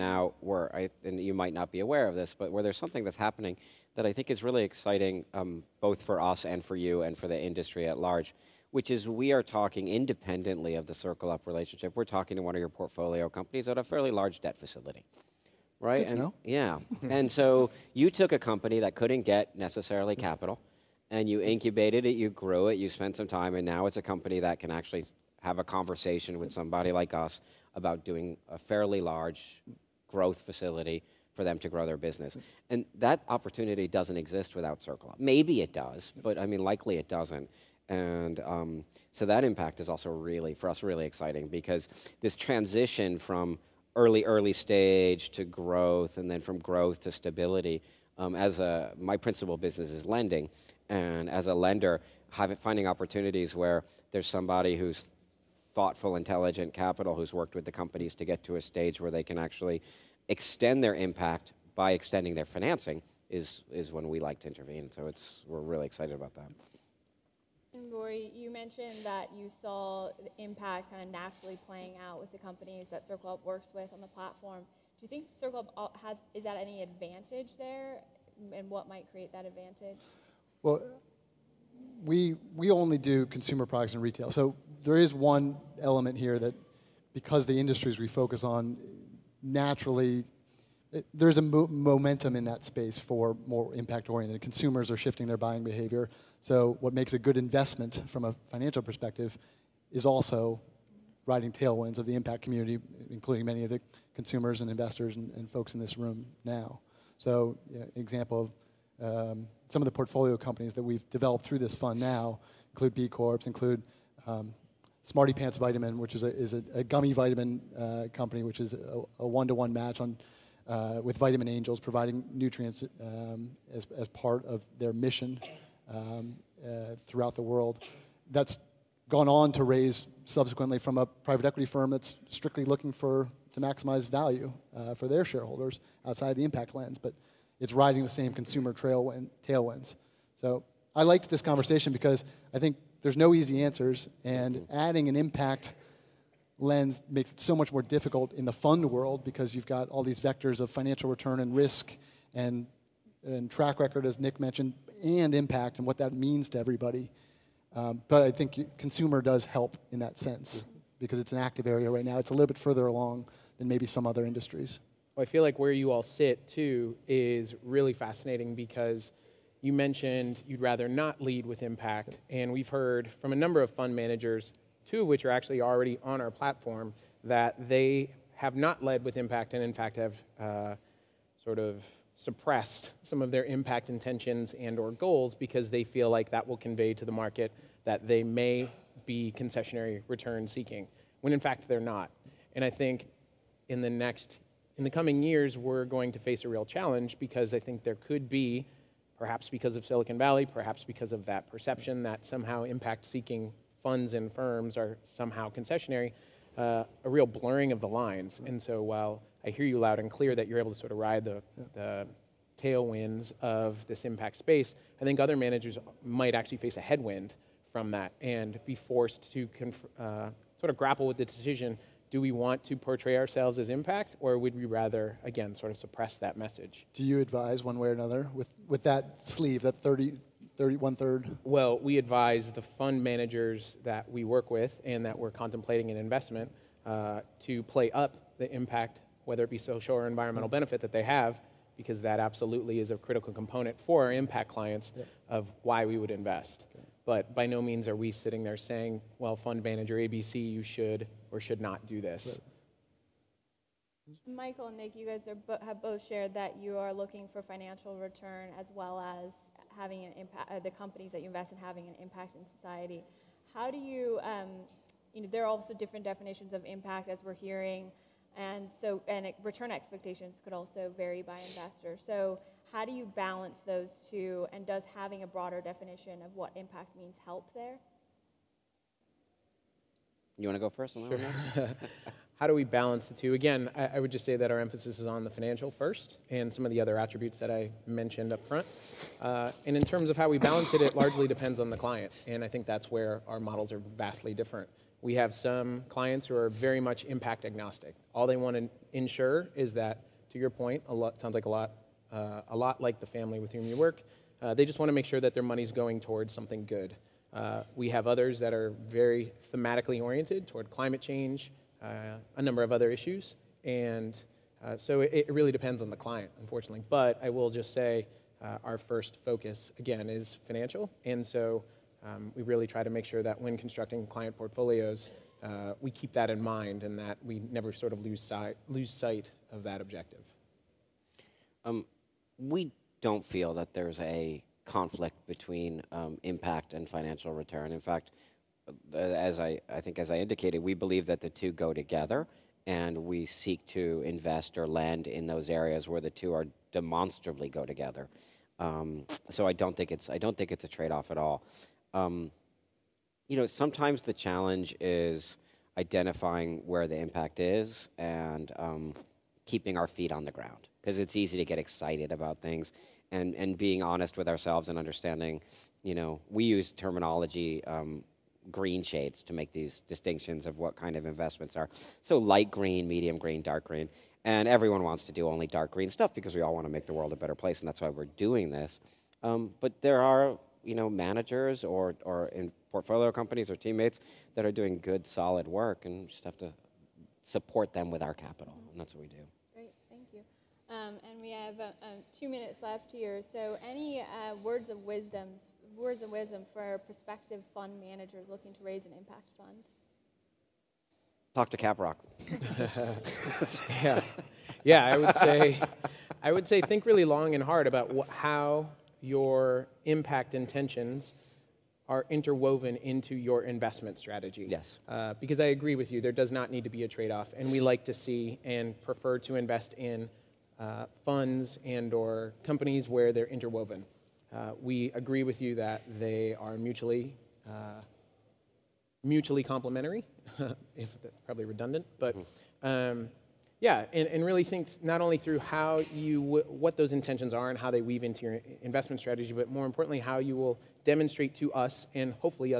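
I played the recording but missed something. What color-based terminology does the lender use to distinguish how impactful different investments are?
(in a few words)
green shades.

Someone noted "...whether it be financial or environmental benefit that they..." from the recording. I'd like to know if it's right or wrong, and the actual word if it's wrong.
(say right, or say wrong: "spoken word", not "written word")
wrong: "social", not "financial".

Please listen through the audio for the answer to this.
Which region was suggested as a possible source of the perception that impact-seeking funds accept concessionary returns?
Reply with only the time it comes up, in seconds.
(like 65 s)
199 s.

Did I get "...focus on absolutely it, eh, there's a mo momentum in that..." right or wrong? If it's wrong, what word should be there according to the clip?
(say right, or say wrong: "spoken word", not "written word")
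wrong: "naturally", not "absolutely".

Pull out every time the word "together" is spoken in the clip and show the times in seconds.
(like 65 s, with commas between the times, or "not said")
341 s, 347 s.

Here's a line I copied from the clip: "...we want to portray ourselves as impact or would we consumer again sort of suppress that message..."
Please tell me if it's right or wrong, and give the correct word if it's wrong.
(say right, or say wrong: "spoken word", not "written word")
wrong: "rather", not "consumer".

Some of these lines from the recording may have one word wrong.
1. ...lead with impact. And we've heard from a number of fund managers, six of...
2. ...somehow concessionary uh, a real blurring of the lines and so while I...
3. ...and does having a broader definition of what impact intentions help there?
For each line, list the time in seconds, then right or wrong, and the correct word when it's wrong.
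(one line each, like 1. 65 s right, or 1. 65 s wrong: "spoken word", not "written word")
1. 171 s wrong: "two", not "six"
2. 205 s right
3. 274 s wrong: "means", not "intentions".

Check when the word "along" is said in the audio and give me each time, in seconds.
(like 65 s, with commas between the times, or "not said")
162 s.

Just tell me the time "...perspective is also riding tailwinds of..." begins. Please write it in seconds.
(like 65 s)
98 s.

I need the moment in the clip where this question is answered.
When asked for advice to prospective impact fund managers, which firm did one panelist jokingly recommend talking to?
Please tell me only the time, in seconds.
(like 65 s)
401 s.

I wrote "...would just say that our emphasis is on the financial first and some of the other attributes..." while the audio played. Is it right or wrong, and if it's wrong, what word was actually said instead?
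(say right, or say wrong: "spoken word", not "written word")
right.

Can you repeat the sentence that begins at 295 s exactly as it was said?
We have some clients who are very much impact agnostic.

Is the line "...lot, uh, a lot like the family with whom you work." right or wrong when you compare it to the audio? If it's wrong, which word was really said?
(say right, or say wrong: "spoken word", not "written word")
right.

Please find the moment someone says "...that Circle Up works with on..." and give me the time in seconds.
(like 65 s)
72 s.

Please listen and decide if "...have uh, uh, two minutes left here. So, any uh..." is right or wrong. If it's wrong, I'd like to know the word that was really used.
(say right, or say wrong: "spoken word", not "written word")
right.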